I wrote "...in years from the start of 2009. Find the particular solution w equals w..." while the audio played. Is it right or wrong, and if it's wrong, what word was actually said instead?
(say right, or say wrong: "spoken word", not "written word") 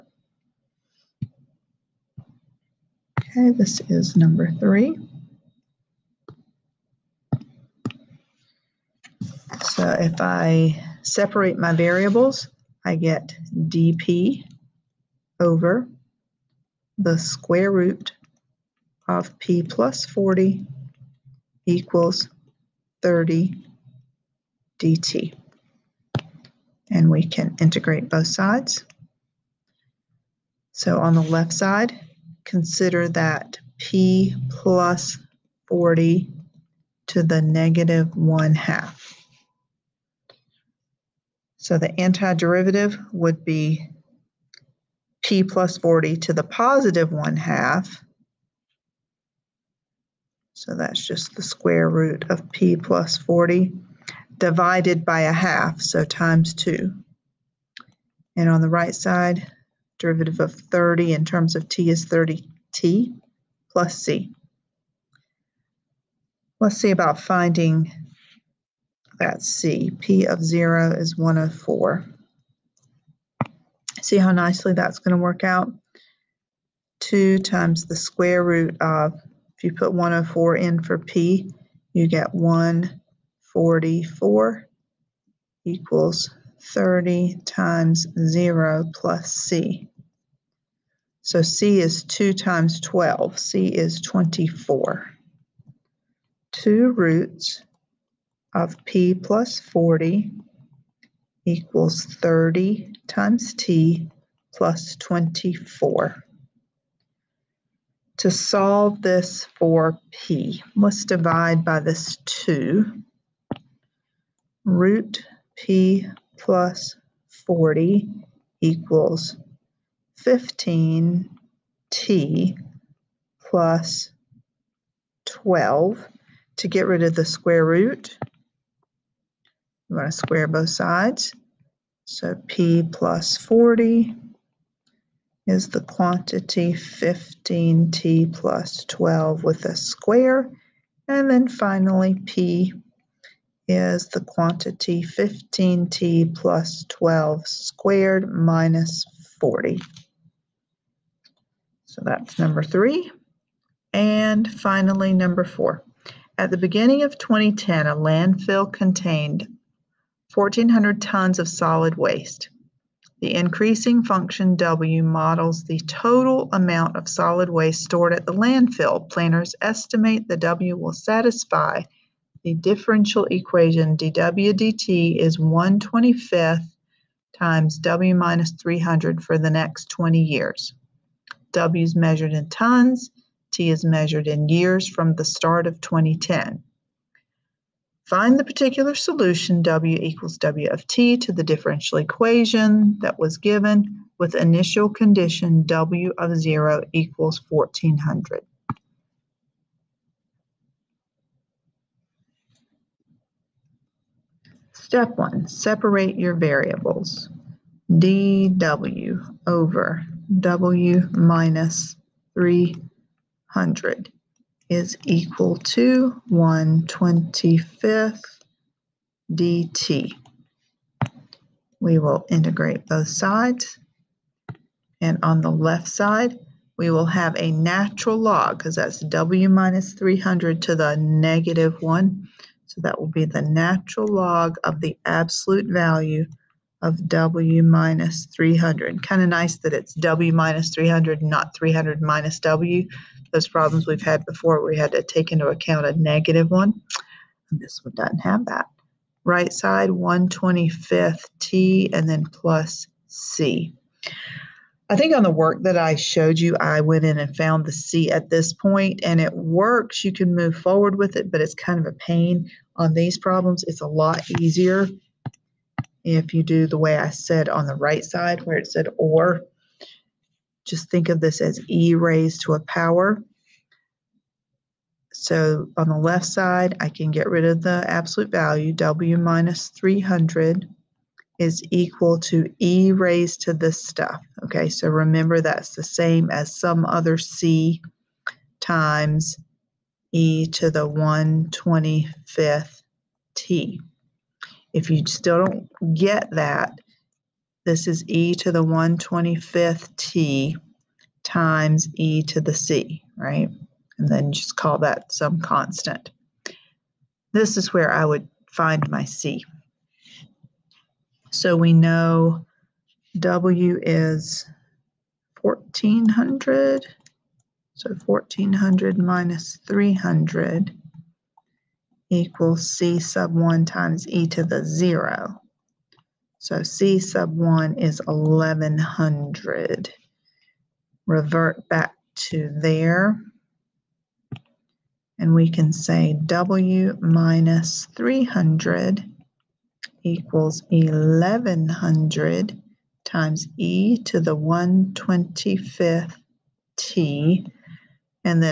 wrong: "2010", not "2009".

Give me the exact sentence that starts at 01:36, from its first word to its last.
Two roots of P plus 40 equals 30 times T plus 24.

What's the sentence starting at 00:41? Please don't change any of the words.
So the antiderivative would be p plus 40 to the positive 1 half.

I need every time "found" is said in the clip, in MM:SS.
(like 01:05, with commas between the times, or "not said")
04:17.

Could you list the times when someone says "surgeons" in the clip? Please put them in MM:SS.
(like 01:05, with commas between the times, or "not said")
not said.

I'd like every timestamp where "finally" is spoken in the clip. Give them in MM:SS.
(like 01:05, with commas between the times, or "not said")
02:21, 02:34.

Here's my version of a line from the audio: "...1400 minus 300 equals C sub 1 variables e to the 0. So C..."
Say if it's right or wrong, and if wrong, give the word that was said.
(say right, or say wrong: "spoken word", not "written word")
wrong: "times", not "variables".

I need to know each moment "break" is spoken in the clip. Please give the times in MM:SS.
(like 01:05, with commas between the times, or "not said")
not said.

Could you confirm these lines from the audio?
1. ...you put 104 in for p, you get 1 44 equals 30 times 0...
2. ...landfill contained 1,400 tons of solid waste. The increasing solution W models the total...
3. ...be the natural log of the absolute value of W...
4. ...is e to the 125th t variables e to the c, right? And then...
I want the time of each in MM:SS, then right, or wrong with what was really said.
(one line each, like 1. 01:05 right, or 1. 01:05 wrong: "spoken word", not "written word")
1. 01:19 right
2. 02:37 wrong: "function", not "solution"
3. 03:53 right
4. 04:57 wrong: "times", not "variables".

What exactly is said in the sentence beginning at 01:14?
See how nicely that's going to work out?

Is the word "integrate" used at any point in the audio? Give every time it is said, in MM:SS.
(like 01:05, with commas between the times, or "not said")
00:27, 03:42.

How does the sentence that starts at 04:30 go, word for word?
Just think of this as e raised to a power.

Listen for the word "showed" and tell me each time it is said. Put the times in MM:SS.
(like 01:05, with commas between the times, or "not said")
04:15.